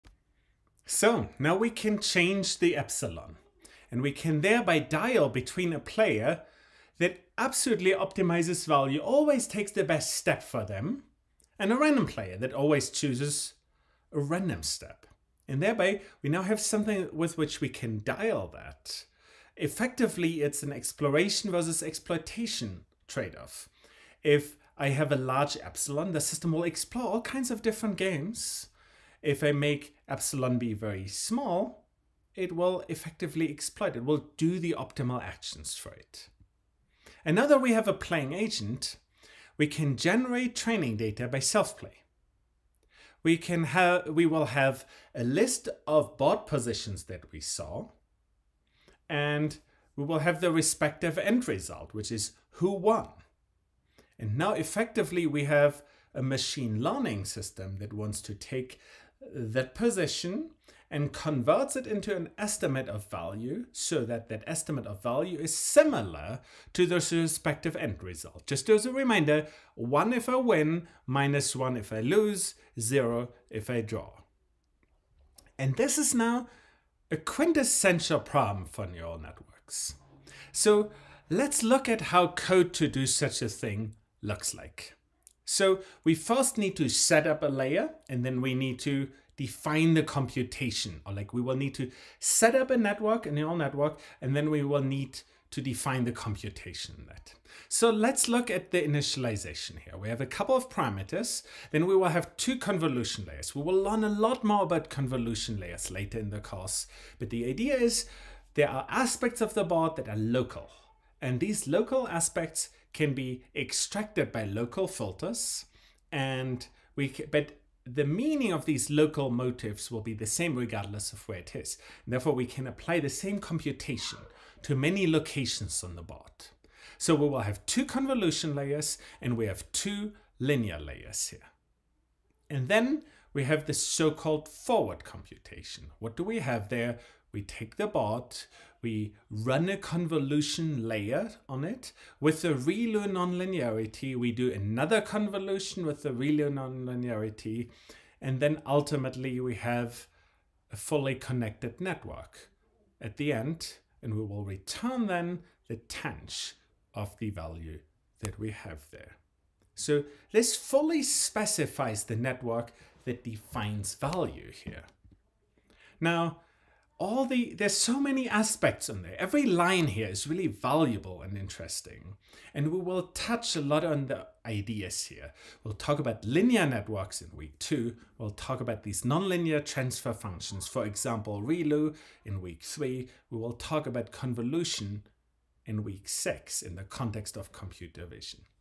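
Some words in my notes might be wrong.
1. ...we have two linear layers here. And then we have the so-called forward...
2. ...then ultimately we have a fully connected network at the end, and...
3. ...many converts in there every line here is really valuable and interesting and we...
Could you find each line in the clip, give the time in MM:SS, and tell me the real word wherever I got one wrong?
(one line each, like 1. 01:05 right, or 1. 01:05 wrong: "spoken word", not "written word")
1. 02:09 right
2. 02:28 right
3. 02:47 wrong: "aspects", not "converts".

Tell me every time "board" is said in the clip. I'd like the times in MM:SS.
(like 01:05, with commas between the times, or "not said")
00:46, 01:49.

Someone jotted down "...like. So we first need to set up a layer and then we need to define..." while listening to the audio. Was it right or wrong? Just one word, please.
right.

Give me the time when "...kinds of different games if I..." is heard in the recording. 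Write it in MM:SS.
00:27.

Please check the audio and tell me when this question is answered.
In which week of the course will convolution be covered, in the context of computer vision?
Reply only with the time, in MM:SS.
03:05.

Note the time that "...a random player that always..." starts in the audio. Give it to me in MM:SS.
00:11.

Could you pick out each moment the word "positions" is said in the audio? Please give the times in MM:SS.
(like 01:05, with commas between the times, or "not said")
00:46, 00:59.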